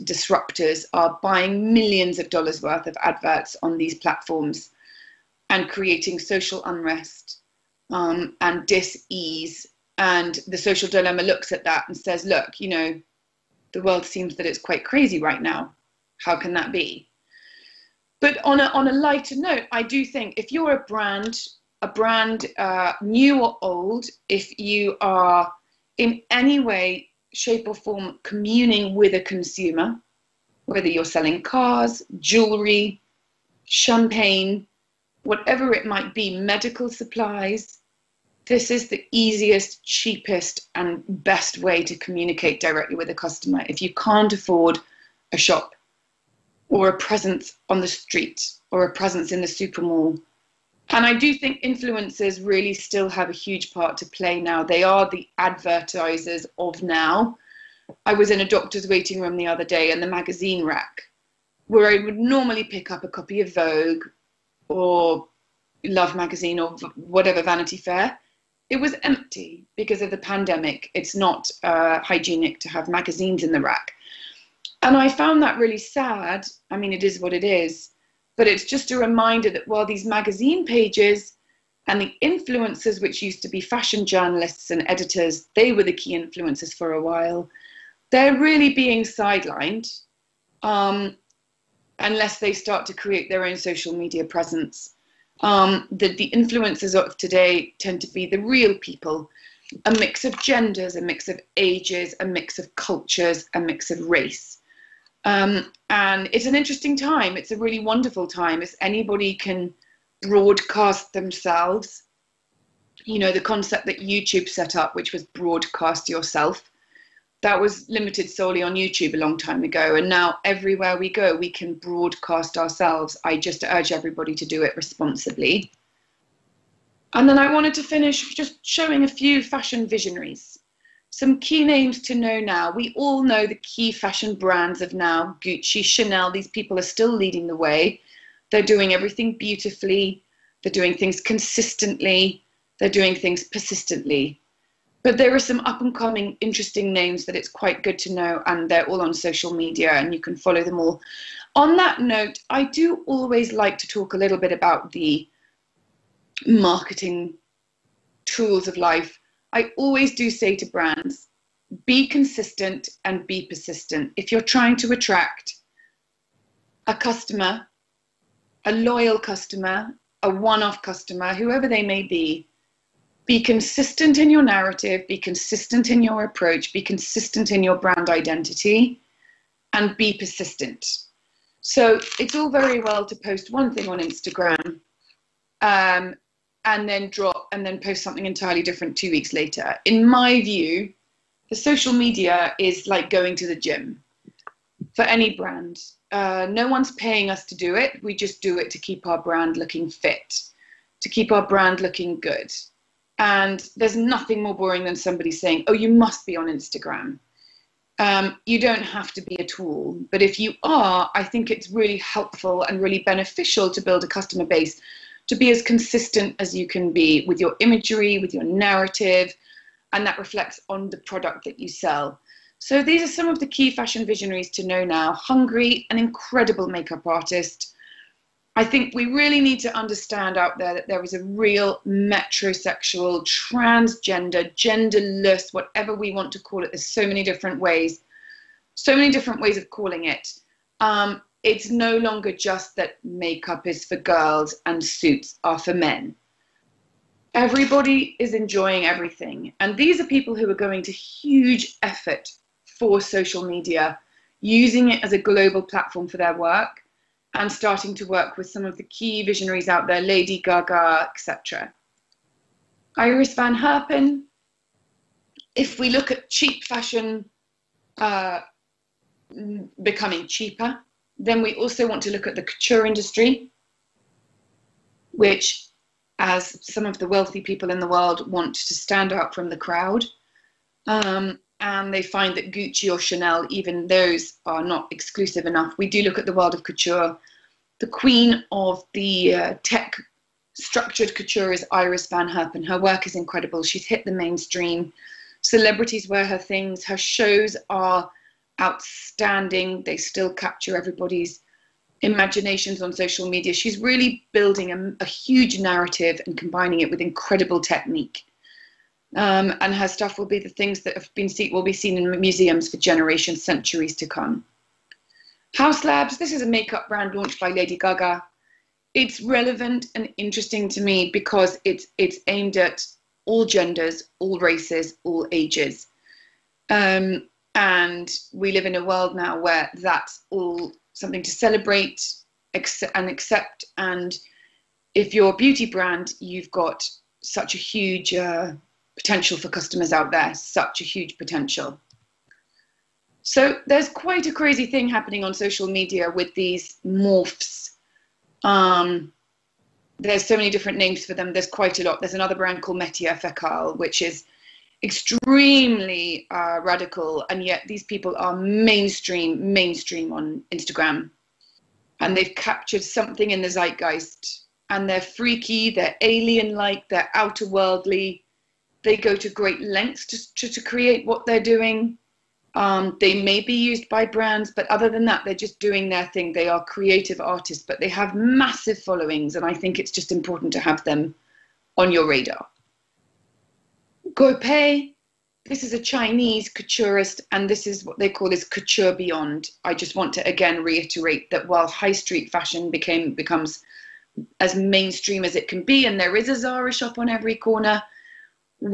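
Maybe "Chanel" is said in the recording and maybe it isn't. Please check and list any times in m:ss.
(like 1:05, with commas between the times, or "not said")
2:15, 4:42.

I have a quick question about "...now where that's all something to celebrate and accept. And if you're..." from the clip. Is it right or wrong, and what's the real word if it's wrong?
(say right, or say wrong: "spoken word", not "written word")
right.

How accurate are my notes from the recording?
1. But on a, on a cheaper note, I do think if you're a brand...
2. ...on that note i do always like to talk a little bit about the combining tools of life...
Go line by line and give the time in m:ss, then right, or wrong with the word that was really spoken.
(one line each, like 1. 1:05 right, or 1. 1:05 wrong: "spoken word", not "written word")
1. 0:18 wrong: "lighter", not "cheaper"
2. 2:31 wrong: "marketing", not "combining".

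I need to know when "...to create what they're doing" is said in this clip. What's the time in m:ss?
6:10.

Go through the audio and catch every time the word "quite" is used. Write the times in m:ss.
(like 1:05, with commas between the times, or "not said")
0:14, 2:27, 5:43, 5:51.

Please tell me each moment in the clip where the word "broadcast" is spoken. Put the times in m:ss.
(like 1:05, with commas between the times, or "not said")
1:50, 1:55, 2:01.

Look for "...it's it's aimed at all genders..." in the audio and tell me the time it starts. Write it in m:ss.
5:21.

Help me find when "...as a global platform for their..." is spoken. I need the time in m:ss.
4:15.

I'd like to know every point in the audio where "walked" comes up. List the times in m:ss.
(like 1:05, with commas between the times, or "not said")
not said.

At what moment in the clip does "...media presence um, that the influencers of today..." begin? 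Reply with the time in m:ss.
1:33.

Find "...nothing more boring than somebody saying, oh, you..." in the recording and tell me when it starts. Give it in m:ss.
3:23.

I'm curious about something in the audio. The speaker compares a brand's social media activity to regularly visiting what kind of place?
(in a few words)
the gym.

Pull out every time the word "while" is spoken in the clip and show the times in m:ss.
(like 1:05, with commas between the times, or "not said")
1:19, 1:27, 6:31.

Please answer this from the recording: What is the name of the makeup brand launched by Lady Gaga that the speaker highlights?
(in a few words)
Haus Labs.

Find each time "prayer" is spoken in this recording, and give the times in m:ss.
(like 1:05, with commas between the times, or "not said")
not said.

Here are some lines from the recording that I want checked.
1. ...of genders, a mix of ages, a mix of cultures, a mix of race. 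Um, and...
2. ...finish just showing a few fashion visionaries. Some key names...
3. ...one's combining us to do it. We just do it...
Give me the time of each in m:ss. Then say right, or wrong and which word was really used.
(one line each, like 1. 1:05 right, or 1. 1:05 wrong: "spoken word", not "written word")
1. 1:40 right
2. 2:07 right
3. 3:16 wrong: "paying", not "combining".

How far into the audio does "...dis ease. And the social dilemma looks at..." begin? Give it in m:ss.
0:08.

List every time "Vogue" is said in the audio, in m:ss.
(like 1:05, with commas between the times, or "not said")
1:03.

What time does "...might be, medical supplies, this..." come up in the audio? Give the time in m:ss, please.
0:35.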